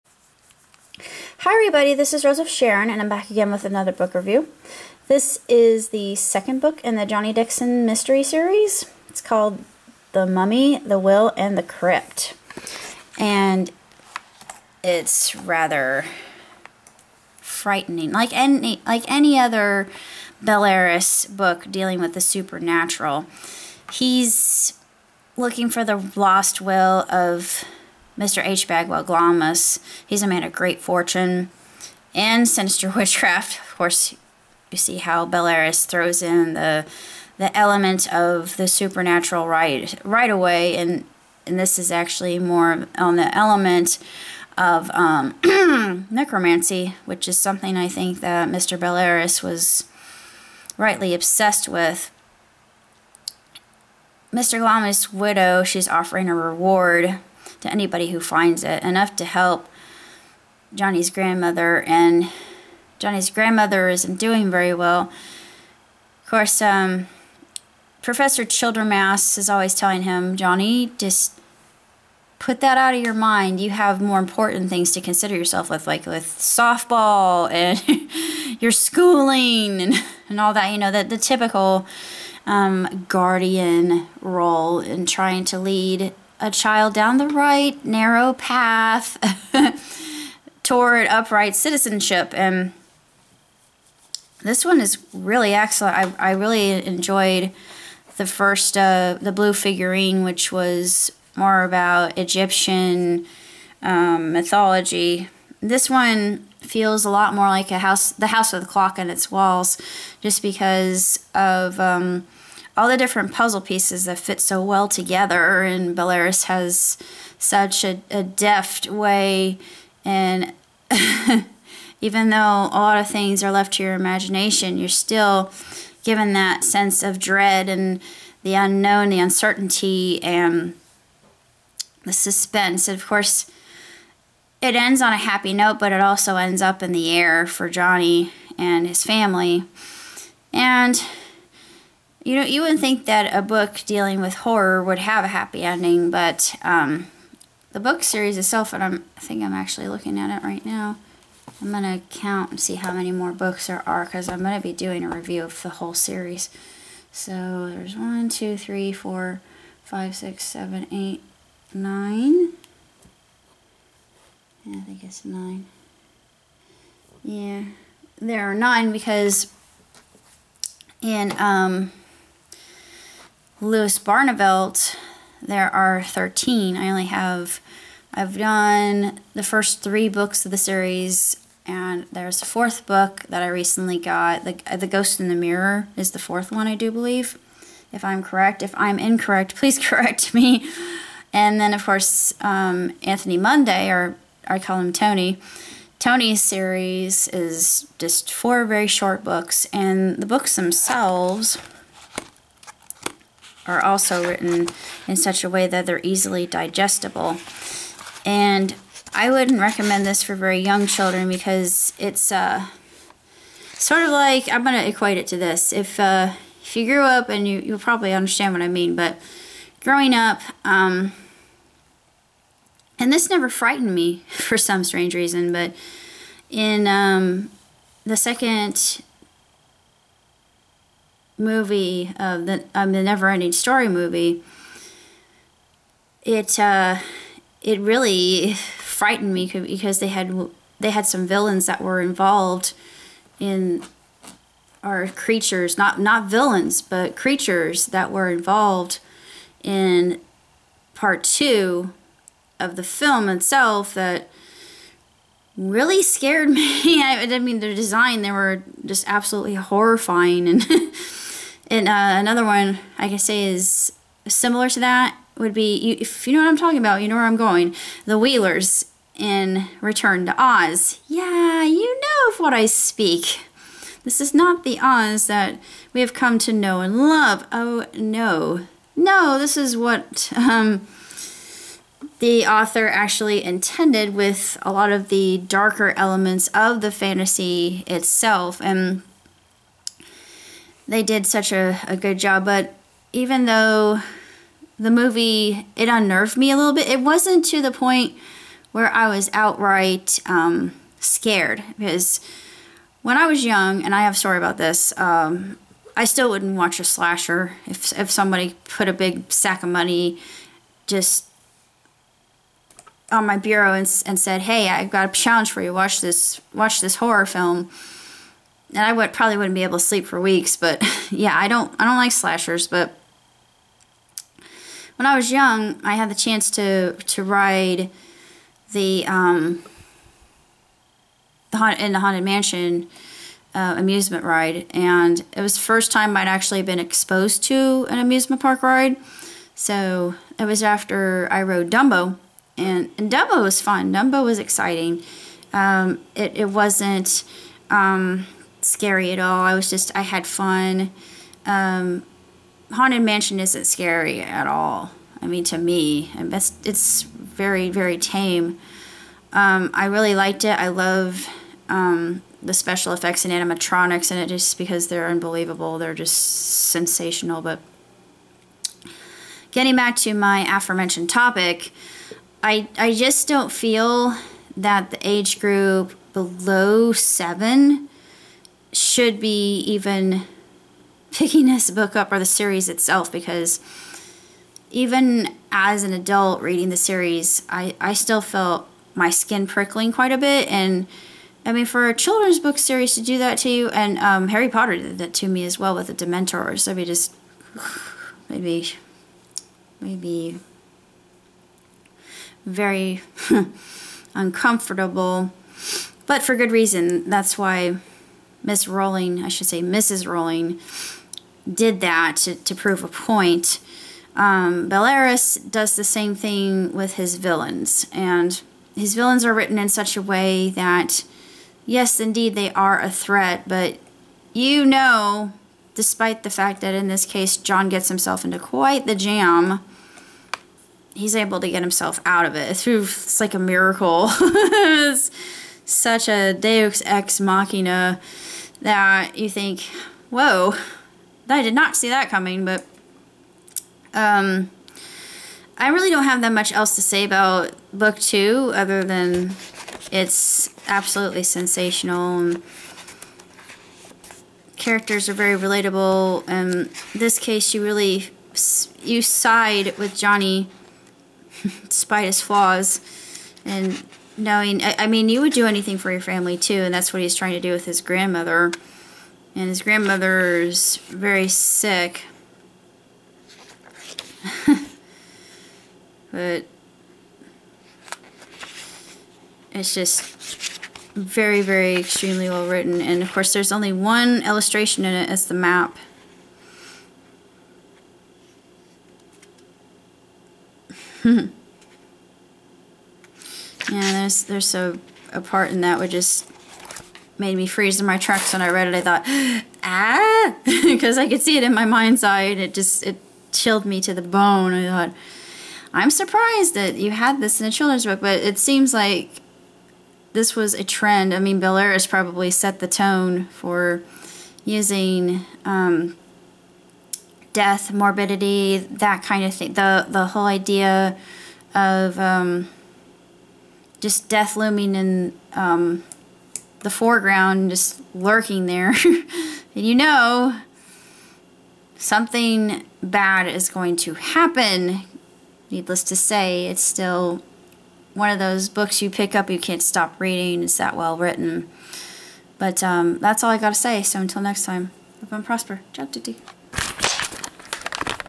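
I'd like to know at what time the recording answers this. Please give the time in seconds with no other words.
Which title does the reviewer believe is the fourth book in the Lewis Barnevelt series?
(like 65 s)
184 s.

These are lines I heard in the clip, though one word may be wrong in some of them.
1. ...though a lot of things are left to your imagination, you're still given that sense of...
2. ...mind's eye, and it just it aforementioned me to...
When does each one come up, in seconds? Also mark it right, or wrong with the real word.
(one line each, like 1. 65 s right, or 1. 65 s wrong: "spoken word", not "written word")
1. 122 s right
2. 501 s wrong: "chilled", not "aforementioned".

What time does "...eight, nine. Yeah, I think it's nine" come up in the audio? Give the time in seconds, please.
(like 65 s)
160 s.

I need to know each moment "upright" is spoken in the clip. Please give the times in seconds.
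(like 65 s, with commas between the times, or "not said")
91 s.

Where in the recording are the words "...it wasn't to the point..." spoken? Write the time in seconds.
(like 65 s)
296 s.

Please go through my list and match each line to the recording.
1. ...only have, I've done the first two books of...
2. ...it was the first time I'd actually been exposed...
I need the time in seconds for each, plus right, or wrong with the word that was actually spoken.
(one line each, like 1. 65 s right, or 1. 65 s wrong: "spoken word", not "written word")
1. 176 s wrong: "three", not "two"
2. 335 s right.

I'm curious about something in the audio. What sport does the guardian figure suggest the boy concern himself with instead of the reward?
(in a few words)
softball.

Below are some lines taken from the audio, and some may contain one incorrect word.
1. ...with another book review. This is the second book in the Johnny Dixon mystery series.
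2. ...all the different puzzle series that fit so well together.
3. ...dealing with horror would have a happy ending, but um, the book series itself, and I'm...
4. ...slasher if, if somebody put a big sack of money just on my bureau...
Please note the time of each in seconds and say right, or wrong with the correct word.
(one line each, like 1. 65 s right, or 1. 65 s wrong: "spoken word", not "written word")
1. 3 s right
2. 112 s wrong: "pieces", not "series"
3. 143 s right
4. 306 s right.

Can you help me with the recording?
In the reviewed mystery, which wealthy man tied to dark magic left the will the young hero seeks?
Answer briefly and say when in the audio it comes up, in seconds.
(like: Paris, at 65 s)
H. Bagwell Glamis, at 28 s.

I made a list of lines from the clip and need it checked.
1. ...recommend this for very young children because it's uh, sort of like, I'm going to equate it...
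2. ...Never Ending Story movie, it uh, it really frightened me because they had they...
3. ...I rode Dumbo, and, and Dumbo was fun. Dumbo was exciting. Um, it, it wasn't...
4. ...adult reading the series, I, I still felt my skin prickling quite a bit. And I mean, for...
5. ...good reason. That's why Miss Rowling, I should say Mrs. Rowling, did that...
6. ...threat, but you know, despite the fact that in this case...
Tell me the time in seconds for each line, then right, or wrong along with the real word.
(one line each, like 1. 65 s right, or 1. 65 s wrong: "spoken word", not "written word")
1. 209 s right
2. 233 s right
3. 341 s right
4. 385 s right
5. 406 s right
6. 422 s right.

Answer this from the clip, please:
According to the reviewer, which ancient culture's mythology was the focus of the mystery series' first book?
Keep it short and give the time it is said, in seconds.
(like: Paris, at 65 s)
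Egyptian, at 102 s.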